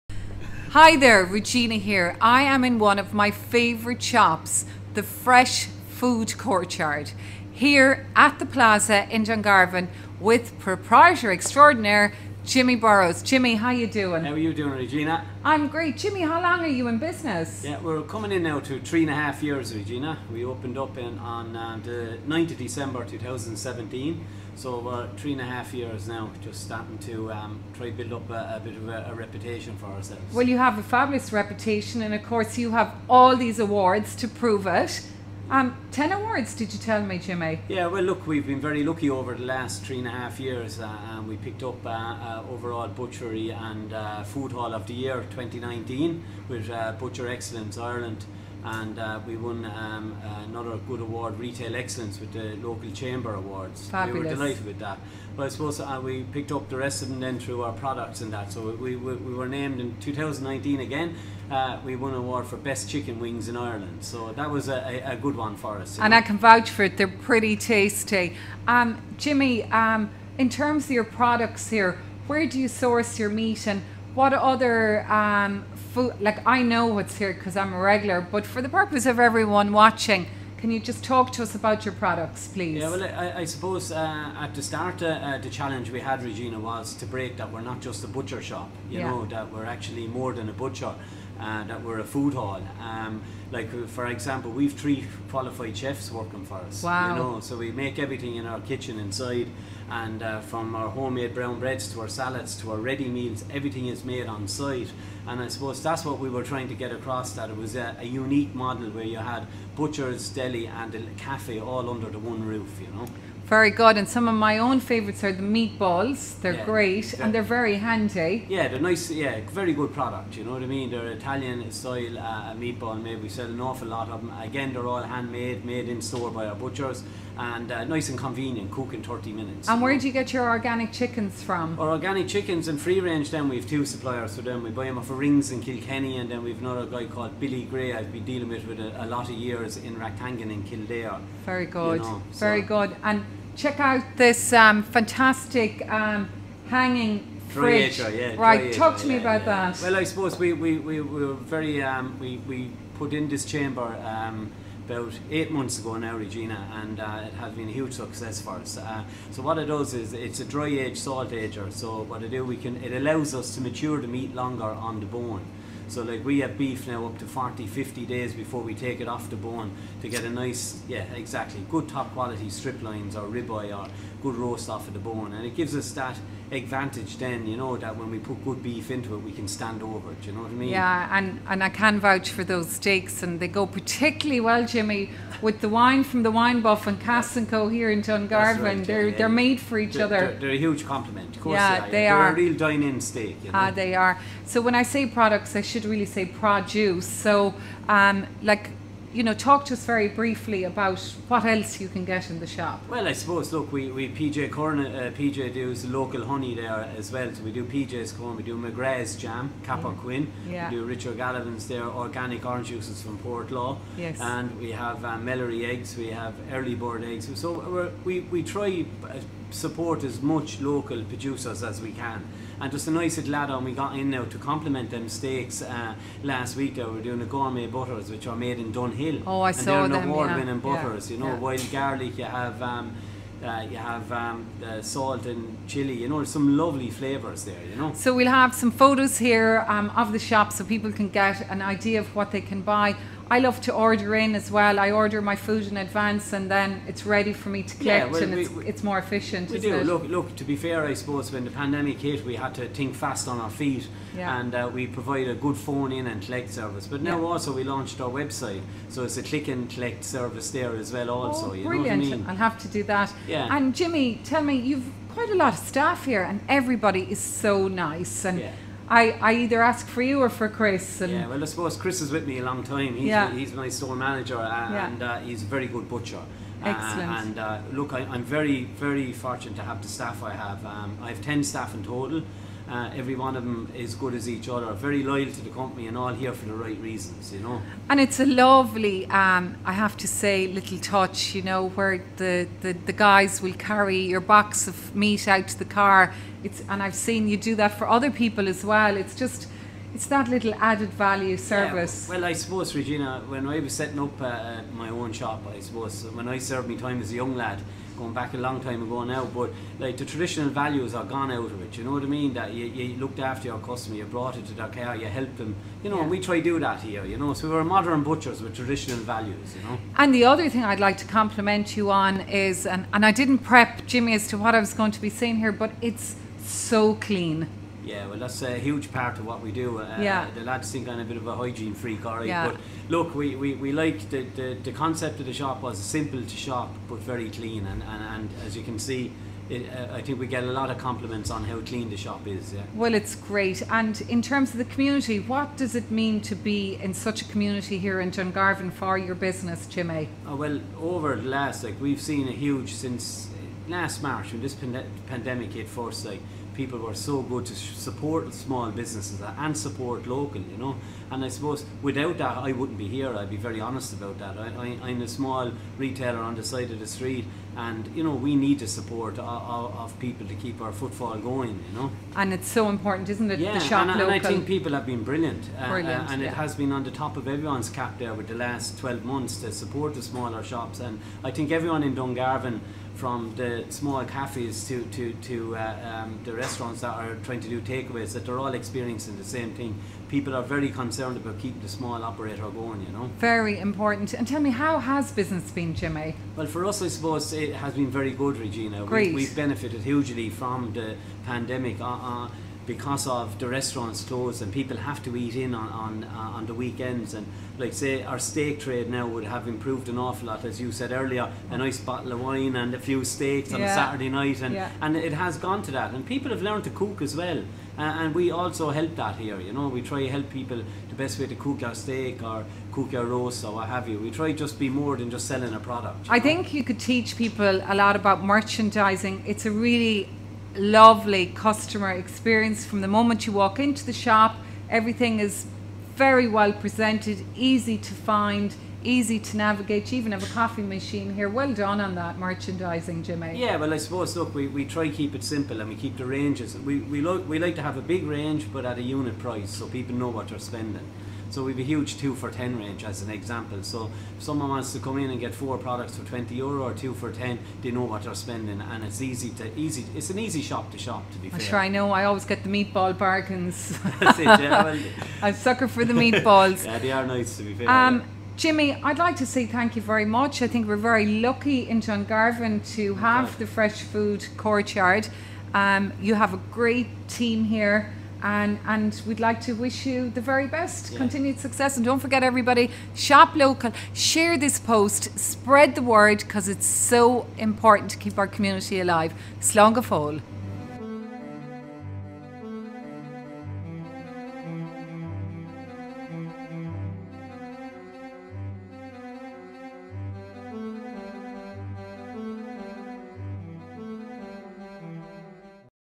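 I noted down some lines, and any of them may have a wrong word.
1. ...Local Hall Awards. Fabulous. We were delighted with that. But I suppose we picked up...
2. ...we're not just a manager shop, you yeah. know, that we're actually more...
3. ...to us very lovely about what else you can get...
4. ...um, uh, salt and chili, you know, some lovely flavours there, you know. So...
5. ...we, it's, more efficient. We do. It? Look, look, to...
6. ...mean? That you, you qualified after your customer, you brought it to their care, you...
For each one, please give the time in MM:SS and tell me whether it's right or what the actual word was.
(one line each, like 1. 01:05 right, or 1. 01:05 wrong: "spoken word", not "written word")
1. 00:52 wrong: "Chamber", not "Hall"
2. 01:27 wrong: "butcher", not "manager"
3. 03:19 wrong: "briefly", not "lovely"
4. 03:54 right
5. 04:08 right
6. 05:12 wrong: "looked", not "qualified".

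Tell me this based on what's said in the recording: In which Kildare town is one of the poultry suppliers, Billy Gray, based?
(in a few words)
Rathangan.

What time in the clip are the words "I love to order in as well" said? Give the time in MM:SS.
04:03.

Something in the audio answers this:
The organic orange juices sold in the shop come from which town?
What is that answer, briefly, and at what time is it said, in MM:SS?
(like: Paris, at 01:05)
Portlaw, at 03:33.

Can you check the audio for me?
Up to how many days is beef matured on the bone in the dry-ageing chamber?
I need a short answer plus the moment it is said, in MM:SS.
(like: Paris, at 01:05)
50 days, at 02:47.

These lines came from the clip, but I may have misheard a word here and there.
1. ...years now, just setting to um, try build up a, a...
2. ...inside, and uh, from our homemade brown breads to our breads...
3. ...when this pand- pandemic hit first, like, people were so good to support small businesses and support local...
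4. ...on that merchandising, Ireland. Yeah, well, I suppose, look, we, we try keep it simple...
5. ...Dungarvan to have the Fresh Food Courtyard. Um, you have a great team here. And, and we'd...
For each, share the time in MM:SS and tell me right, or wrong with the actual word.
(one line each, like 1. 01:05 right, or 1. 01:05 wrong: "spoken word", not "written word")
1. 00:25 wrong: "starting", not "setting"
2. 01:38 wrong: "salads", not "breads"
3. 05:54 right
4. 07:21 wrong: "Jimmy", not "Ireland"
5. 07:51 right.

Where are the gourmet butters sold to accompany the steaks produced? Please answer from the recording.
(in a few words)
Dunhill.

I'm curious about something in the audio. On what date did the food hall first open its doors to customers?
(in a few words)
9 December 2017.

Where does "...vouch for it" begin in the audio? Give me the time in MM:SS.
01:06.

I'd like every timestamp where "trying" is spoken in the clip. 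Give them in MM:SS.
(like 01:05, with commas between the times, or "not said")
01:46, 06:27.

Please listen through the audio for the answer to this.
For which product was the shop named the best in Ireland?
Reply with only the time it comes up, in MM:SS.
01:02.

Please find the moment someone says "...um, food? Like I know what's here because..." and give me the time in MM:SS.
01:15.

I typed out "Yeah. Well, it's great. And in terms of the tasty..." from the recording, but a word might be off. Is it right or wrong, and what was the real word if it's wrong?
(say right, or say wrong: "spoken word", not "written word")
wrong: "community", not "tasty".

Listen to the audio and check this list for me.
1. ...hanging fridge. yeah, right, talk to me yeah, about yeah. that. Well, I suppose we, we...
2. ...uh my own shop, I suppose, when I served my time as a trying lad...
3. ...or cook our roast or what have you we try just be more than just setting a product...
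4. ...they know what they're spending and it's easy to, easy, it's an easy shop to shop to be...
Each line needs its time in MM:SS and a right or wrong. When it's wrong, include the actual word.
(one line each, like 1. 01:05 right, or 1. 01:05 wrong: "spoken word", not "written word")
1. 02:26 right
2. 05:04 wrong: "young", not "trying"
3. 07:02 wrong: "selling", not "setting"
4. 07:37 right.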